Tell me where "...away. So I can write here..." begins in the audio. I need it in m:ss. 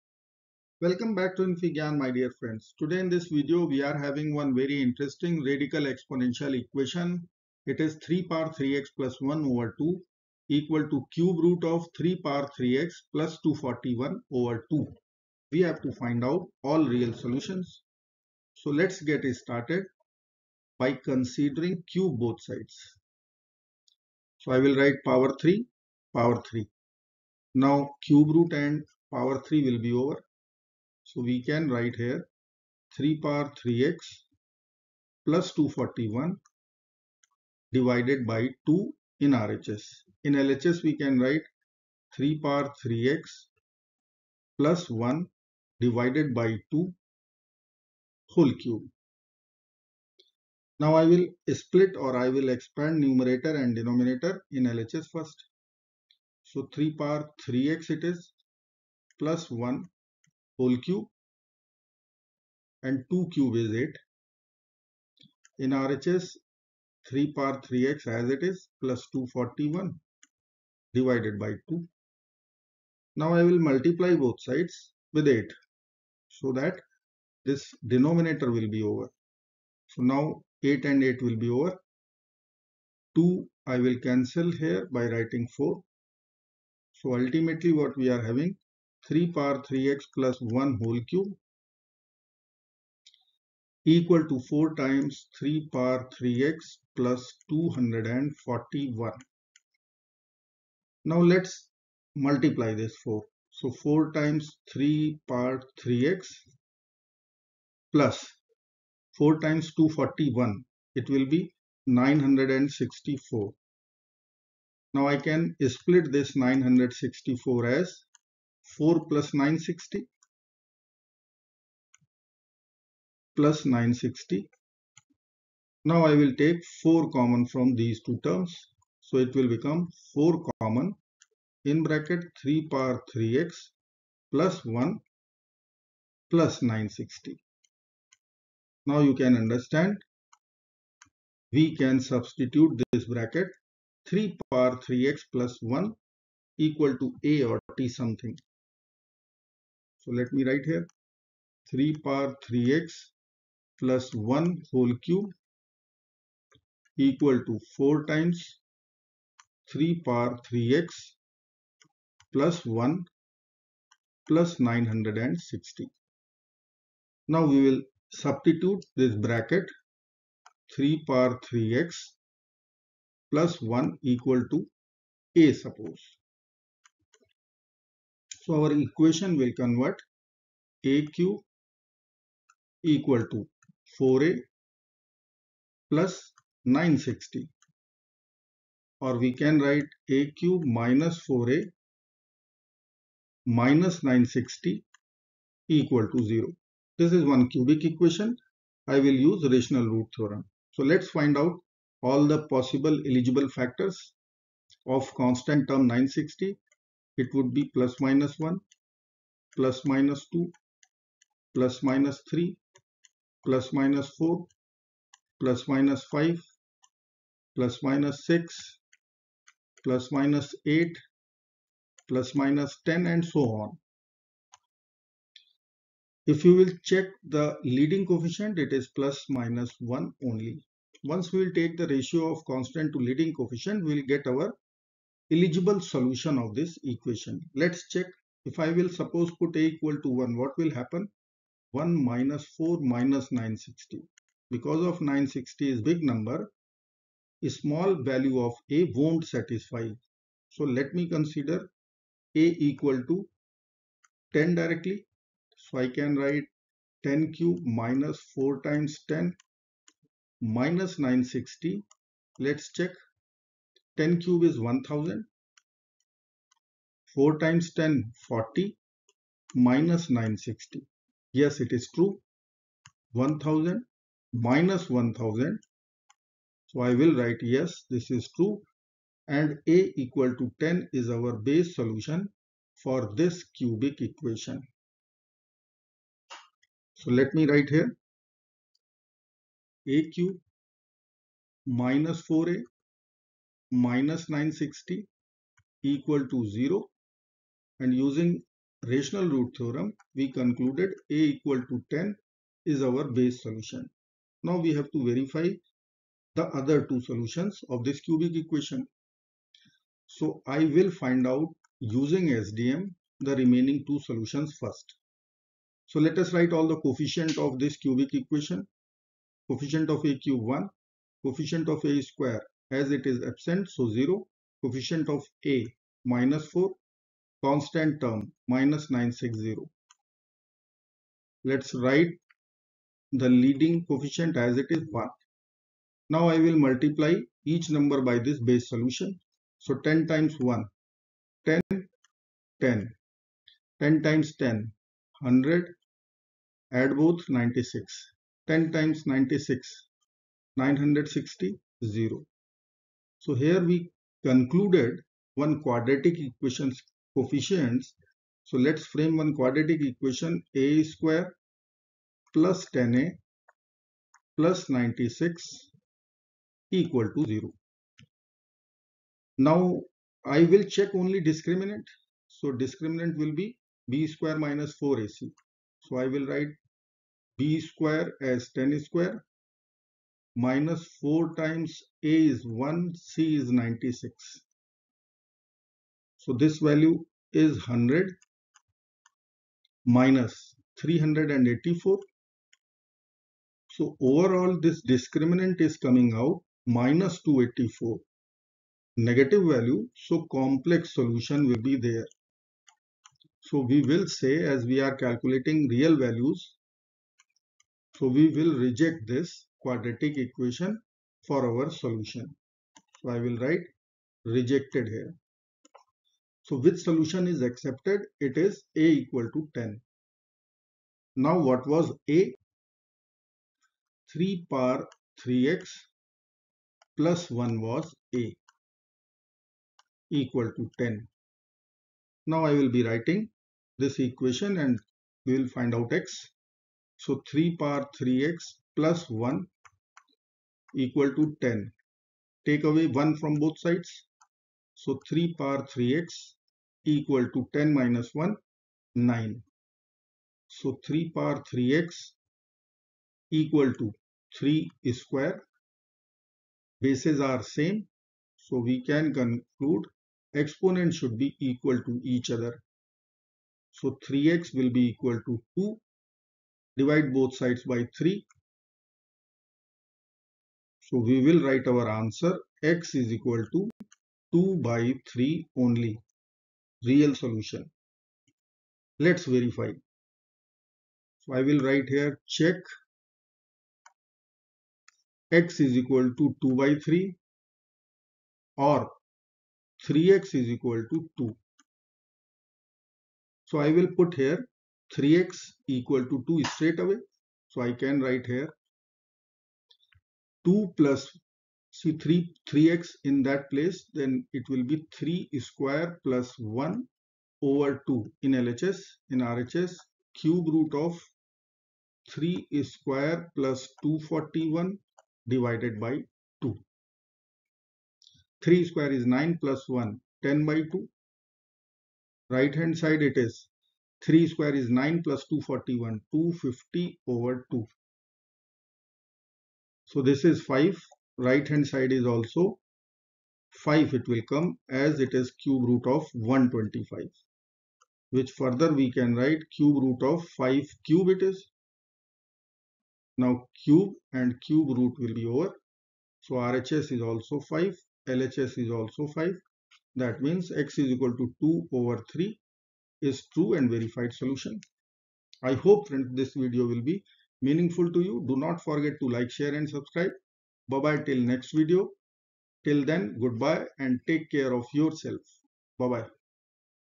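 8:16.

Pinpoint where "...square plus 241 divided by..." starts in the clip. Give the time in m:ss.
8:32.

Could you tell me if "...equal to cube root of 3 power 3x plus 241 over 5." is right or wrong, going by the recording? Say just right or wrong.
wrong.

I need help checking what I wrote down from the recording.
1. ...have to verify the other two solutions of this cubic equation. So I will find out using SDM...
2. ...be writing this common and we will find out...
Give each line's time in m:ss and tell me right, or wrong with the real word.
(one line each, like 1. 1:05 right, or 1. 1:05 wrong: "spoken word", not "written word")
1. 5:04 right
2. 7:12 wrong: "equation", not "common".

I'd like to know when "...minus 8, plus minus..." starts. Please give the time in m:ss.
3:40.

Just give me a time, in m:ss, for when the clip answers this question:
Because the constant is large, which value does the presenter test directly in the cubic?
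4:12.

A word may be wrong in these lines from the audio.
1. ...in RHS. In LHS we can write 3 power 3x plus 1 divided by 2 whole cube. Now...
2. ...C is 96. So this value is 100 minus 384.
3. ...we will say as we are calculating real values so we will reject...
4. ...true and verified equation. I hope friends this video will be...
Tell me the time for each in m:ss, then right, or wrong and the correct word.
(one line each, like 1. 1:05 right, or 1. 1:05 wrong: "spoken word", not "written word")
1. 0:39 right
2. 6:22 right
3. 6:43 right
4. 9:13 wrong: "solution", not "equation".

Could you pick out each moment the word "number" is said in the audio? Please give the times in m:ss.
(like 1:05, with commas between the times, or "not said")
4:06, 5:37.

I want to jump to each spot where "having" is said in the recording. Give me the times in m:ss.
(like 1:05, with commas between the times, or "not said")
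0:03, 1:28.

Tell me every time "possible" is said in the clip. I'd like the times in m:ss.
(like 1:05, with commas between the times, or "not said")
3:22.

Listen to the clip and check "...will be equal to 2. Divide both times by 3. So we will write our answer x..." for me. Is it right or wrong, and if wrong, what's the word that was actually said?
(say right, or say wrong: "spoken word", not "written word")
wrong: "sides", not "times".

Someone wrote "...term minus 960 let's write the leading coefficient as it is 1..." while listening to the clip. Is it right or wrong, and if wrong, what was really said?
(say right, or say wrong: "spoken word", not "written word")
right.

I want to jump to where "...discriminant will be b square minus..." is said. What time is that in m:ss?
6:12.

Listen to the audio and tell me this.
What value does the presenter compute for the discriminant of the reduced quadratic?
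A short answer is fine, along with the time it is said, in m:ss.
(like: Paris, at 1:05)
-284, at 6:36.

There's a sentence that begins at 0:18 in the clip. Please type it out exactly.
So let's get started by considering cube both sides.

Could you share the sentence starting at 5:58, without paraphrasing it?
So let's frame one quadratic equation a square plus 10a plus 96 equal to 0.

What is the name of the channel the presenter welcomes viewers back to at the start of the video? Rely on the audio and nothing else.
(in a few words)
infyGyan.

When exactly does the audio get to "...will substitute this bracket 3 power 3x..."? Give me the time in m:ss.
2:47.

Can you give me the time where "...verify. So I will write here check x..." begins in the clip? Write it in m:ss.
7:59.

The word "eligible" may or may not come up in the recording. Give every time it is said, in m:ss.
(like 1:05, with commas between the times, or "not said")
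3:23, 3:55.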